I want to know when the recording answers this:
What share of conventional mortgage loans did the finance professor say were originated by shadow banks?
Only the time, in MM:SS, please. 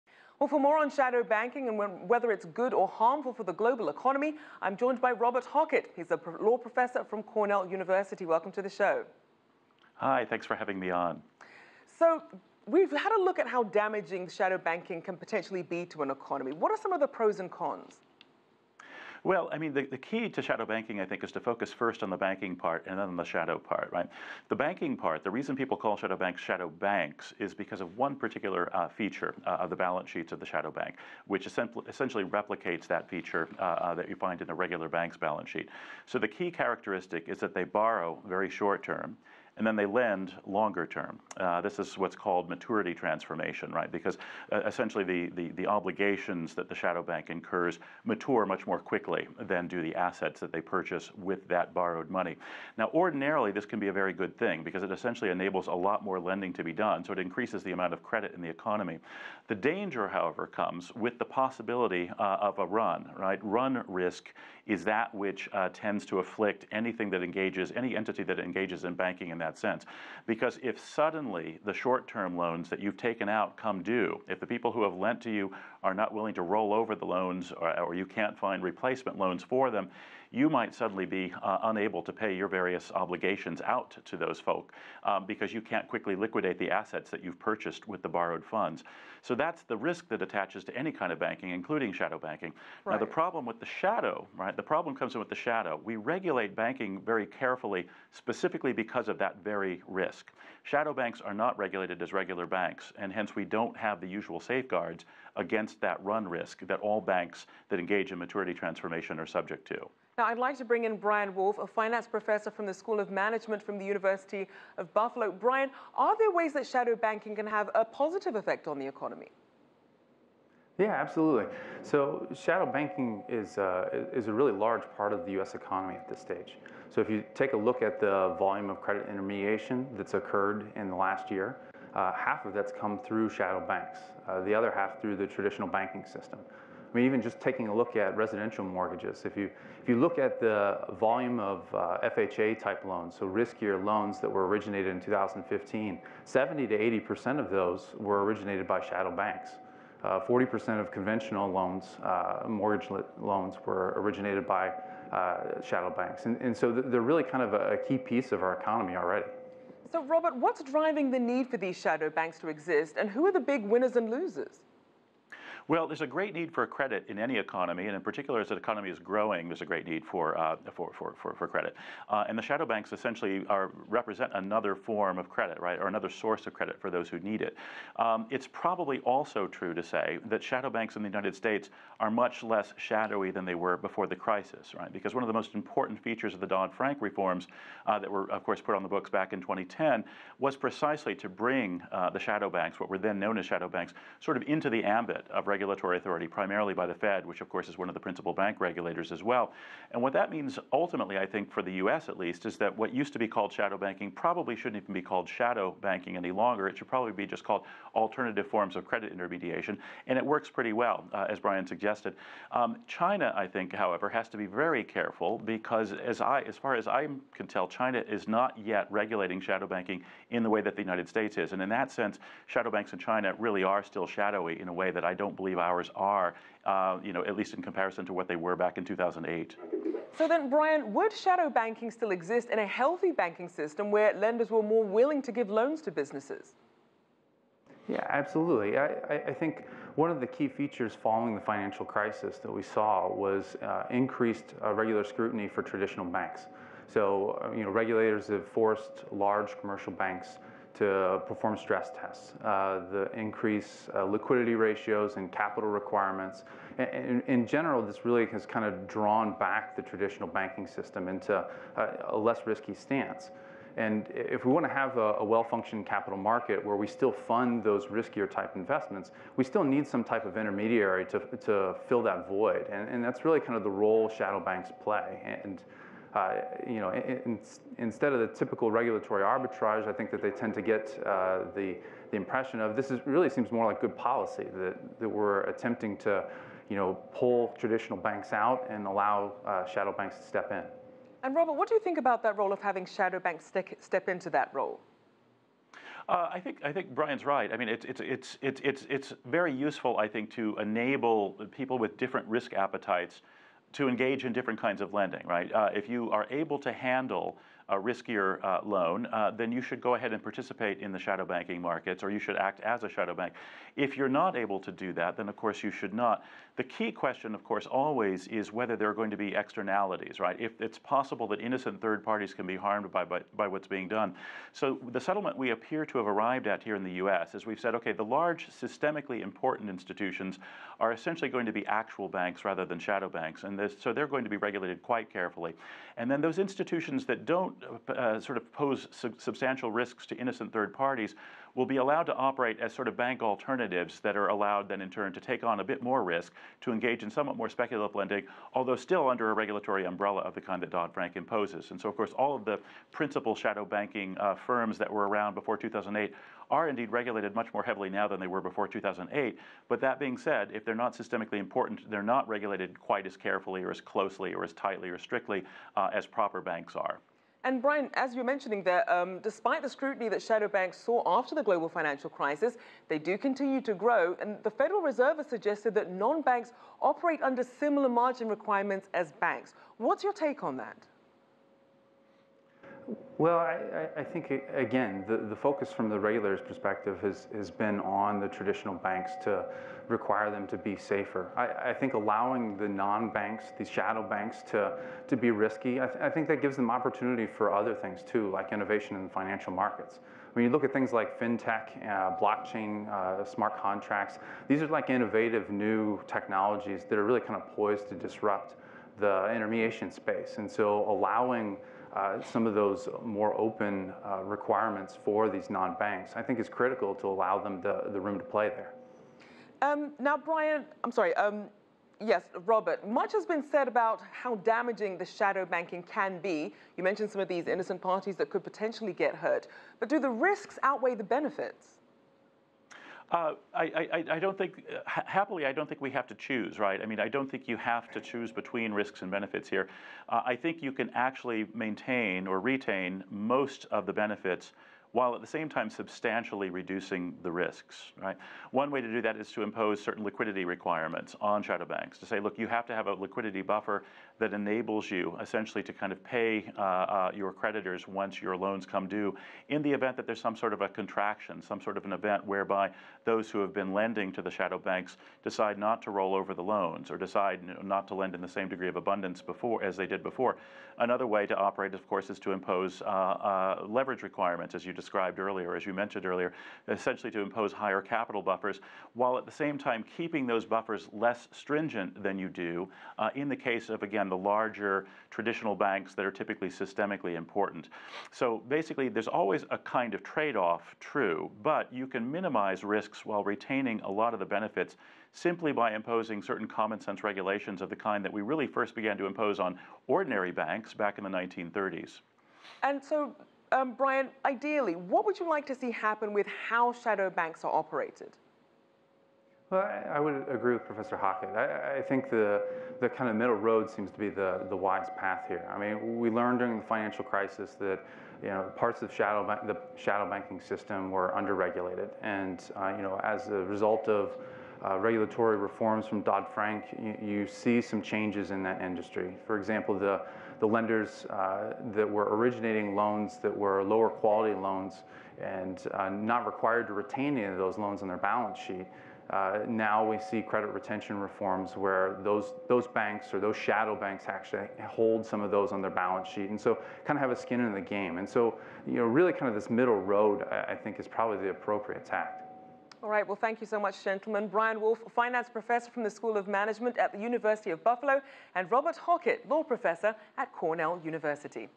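02:30.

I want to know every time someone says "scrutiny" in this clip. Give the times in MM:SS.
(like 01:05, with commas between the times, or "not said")
04:05, 06:09.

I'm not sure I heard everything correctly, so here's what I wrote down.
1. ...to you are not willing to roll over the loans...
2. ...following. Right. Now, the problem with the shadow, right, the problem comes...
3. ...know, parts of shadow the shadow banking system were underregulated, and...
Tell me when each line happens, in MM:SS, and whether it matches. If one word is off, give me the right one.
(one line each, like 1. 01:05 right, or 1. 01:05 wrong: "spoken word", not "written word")
1. 01:15 right
2. 01:32 wrong: "banking", not "following"
3. 08:38 right.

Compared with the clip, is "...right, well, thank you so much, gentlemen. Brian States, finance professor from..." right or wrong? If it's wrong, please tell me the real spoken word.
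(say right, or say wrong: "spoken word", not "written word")
wrong: "Wolfe", not "States".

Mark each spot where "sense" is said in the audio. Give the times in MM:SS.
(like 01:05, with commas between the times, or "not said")
01:09, 03:41, 08:16.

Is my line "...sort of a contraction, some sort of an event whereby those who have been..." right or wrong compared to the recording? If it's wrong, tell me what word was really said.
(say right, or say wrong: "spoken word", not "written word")
right.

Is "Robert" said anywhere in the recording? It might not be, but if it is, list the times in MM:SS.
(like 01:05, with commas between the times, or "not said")
00:05, 02:40, 04:51, 07:02, 09:18.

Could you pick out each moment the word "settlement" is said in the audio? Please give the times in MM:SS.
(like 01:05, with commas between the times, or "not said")
05:24.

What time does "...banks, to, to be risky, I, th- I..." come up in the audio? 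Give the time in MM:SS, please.
06:34.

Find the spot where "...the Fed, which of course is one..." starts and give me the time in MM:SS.
03:16.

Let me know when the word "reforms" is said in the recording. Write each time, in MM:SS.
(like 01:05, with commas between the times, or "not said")
03:06, 08:45, 09:00.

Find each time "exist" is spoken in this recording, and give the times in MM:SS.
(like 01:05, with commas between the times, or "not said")
02:42, 03:52.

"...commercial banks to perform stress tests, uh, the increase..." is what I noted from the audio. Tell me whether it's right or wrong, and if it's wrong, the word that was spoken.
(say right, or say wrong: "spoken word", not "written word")
right.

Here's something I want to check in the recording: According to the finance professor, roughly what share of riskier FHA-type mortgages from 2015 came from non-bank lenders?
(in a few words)
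70 to 80%.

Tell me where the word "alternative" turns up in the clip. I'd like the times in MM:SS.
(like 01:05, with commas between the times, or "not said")
03:27, 05:43.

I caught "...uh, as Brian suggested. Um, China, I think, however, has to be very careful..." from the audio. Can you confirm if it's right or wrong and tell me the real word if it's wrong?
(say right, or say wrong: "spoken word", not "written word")
right.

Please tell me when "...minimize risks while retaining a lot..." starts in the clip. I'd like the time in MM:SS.
08:12.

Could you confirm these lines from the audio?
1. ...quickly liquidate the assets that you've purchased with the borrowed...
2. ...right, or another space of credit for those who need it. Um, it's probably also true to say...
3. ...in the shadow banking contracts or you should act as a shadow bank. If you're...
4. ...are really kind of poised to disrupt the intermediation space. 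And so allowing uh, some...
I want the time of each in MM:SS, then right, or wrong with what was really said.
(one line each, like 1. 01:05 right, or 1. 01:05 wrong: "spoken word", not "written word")
1. 01:25 right
2. 02:55 wrong: "source", not "space"
3. 05:10 wrong: "markets", not "contracts"
4. 06:46 right.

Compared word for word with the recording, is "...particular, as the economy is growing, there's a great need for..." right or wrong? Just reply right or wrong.
right.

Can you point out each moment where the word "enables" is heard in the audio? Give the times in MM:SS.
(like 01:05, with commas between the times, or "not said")
00:55, 05:00, 07:34.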